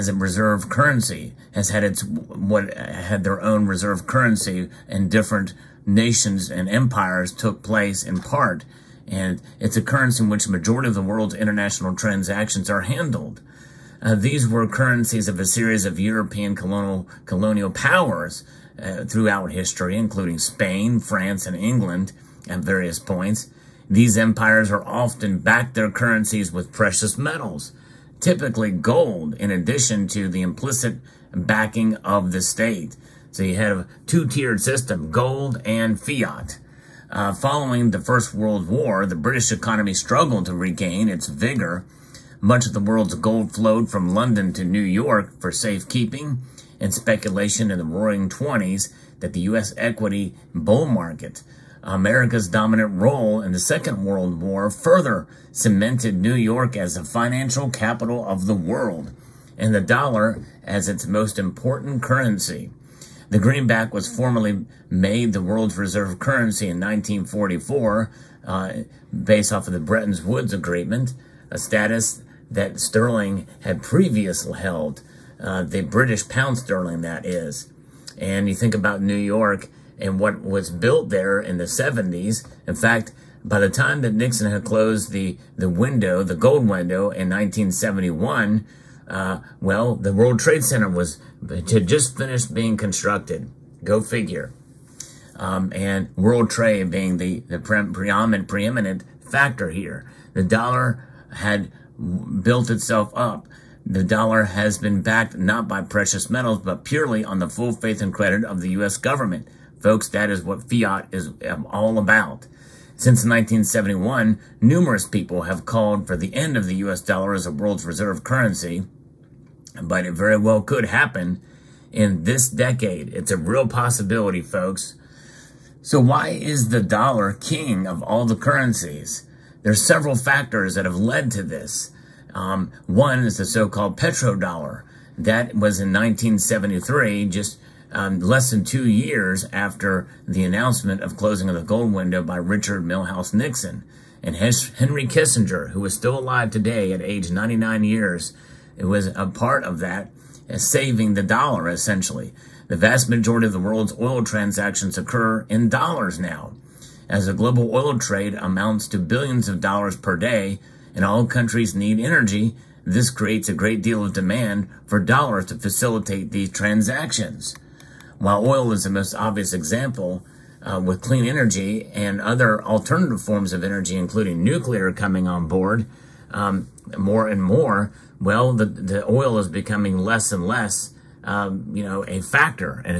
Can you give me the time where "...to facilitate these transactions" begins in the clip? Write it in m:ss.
2:45.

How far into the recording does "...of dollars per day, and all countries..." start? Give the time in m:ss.
2:39.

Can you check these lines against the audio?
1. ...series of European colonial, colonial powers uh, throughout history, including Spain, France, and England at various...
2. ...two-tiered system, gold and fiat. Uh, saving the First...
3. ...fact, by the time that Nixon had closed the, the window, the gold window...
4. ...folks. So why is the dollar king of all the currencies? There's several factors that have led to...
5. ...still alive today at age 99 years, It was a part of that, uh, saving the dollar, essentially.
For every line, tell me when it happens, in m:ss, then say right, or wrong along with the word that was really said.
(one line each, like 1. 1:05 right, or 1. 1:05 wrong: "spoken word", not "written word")
1. 0:15 right
2. 0:34 wrong: "following", not "saving"
3. 1:22 right
4. 2:04 right
5. 2:25 right.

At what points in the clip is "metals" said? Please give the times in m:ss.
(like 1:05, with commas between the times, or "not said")
0:27, 1:46.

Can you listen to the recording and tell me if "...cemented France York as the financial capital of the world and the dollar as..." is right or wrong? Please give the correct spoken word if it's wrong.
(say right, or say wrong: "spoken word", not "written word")
wrong: "New", not "France".